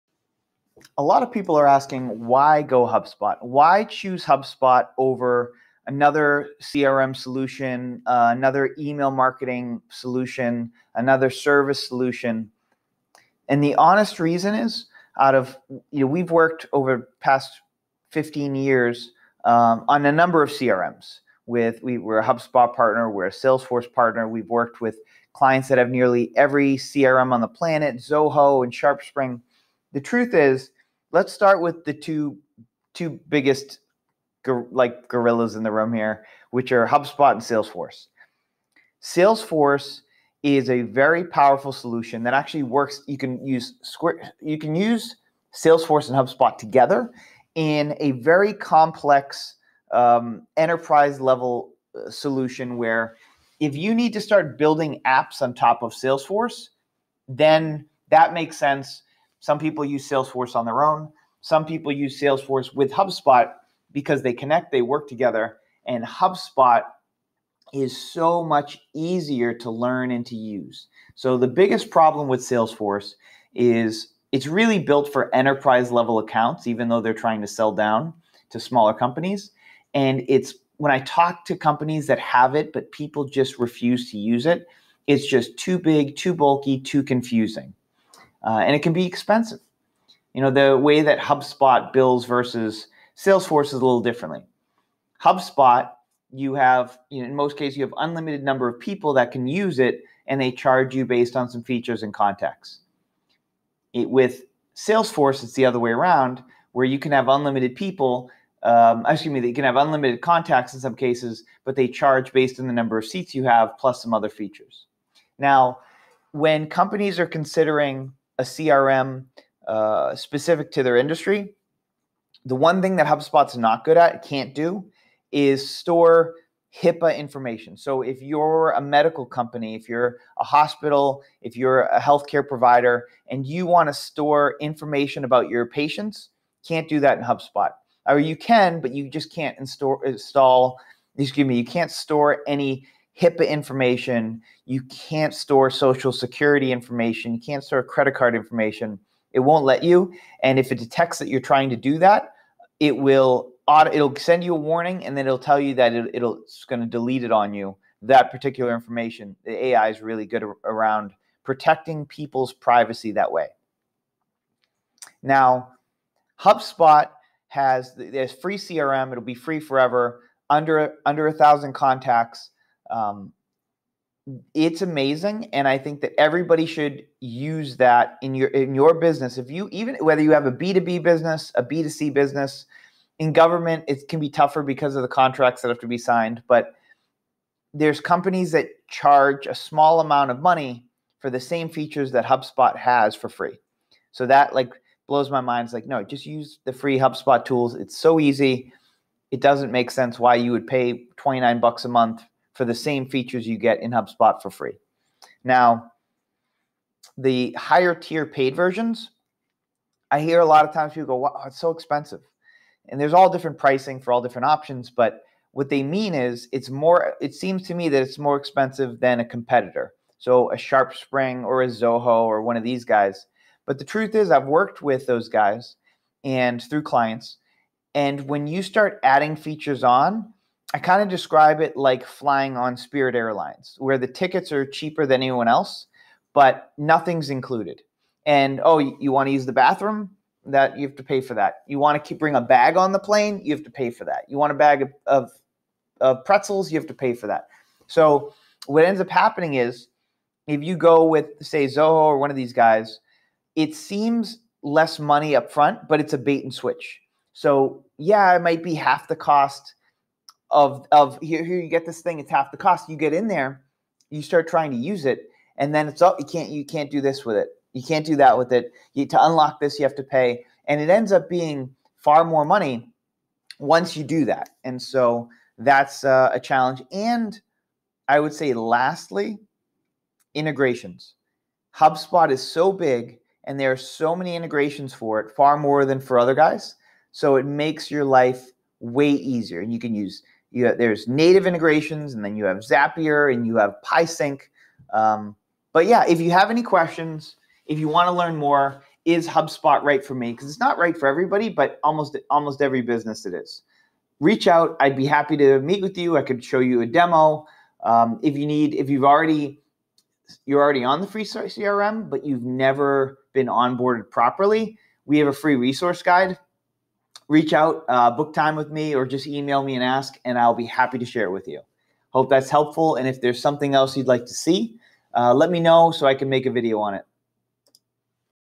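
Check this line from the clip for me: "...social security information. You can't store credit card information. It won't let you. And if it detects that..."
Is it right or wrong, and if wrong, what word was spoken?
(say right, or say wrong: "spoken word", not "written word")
right.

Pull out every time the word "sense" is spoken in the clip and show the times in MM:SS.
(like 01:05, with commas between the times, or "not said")
00:58, 03:19.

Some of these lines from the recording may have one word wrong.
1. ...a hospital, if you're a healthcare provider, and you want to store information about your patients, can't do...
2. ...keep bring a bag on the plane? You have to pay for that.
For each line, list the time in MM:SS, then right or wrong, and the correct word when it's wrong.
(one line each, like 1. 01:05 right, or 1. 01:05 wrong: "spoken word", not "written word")
1. 02:10 right
2. 04:02 right.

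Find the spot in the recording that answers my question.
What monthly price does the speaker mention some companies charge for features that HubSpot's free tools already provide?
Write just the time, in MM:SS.
03:21.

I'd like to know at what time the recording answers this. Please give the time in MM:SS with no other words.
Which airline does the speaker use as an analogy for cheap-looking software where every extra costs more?
03:52.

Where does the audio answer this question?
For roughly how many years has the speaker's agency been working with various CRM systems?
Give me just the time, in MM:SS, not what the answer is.
00:18.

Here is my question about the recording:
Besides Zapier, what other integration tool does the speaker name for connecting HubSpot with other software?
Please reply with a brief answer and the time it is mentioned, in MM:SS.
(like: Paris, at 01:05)
PieSync, at 04:53.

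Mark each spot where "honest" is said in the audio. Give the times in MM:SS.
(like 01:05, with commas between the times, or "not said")
00:13.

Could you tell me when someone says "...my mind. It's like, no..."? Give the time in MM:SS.
03:15.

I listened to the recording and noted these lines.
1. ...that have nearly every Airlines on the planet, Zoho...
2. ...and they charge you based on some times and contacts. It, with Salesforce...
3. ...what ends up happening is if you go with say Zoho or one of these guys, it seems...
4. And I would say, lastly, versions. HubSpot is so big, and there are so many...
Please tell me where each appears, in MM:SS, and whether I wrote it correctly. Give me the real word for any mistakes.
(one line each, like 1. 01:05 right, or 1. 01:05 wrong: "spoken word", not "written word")
1. 00:25 wrong: "CRM", not "Airlines"
2. 01:40 wrong: "features", not "times"
3. 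04:08 right
4. 04:36 wrong: "integrations", not "versions".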